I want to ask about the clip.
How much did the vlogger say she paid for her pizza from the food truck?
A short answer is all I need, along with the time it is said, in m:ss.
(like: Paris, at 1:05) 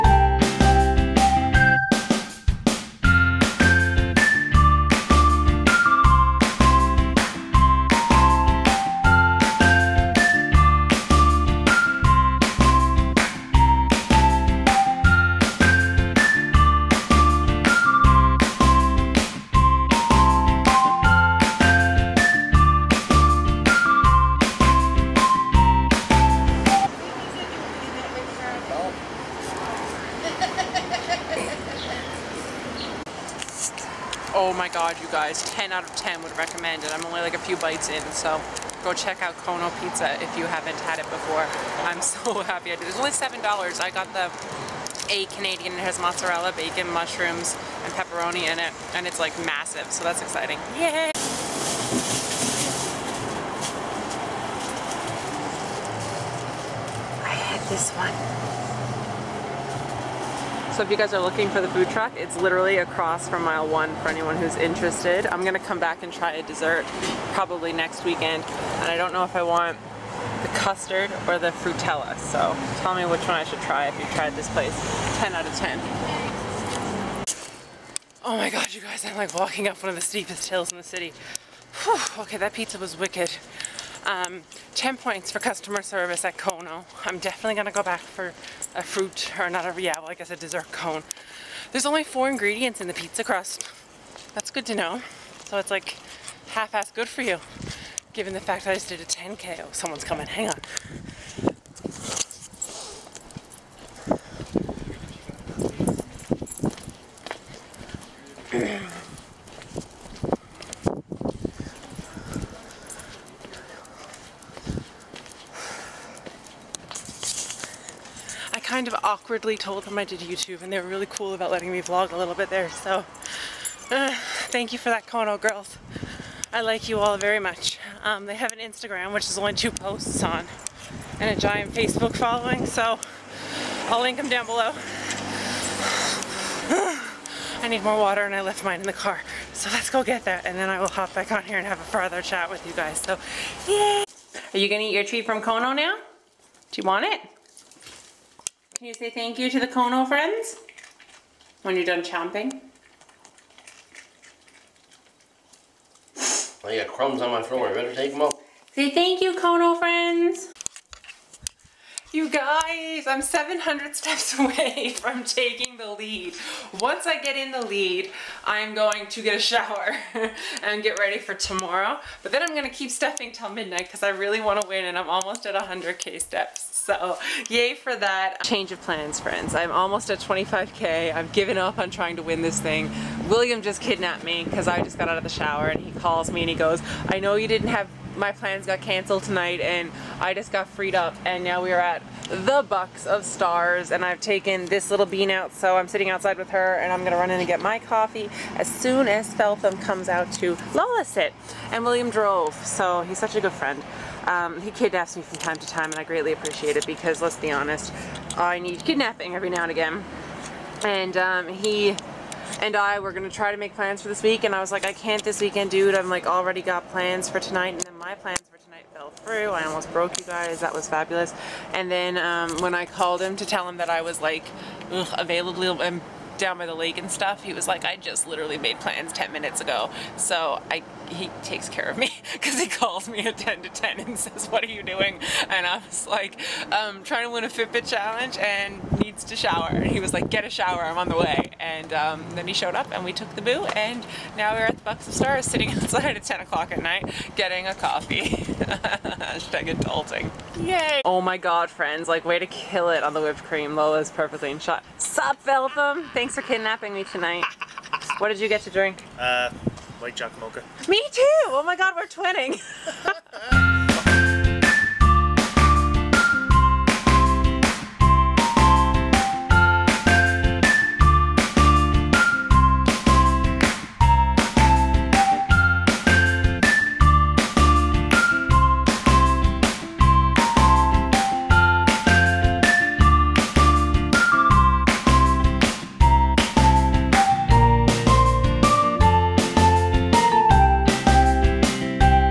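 $7, at 0:43.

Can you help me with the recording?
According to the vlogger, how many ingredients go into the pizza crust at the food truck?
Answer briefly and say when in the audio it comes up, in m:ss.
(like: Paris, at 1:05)
4, at 1:32.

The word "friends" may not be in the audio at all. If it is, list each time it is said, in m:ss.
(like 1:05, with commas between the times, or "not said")
2:30, 2:39, 2:59, 3:23, 4:11.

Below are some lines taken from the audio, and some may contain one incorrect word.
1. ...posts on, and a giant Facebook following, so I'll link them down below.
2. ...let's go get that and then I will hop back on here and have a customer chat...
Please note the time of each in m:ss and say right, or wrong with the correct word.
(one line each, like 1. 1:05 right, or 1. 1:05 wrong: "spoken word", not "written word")
1. 2:09 right
2. 2:19 wrong: "further", not "customer".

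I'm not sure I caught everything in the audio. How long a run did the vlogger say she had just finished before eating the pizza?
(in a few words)
10K.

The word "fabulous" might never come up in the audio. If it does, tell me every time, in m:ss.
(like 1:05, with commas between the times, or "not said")
3:40.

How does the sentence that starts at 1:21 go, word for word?
Whew, okay, that pizza was wicked.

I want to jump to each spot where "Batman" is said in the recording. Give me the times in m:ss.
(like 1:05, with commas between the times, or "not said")
not said.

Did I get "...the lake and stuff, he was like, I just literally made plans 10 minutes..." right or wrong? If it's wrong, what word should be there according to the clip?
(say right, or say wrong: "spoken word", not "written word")
right.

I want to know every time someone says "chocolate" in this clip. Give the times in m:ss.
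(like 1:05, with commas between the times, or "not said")
4:20.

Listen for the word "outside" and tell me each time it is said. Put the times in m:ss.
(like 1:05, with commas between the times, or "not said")
3:16, 4:05.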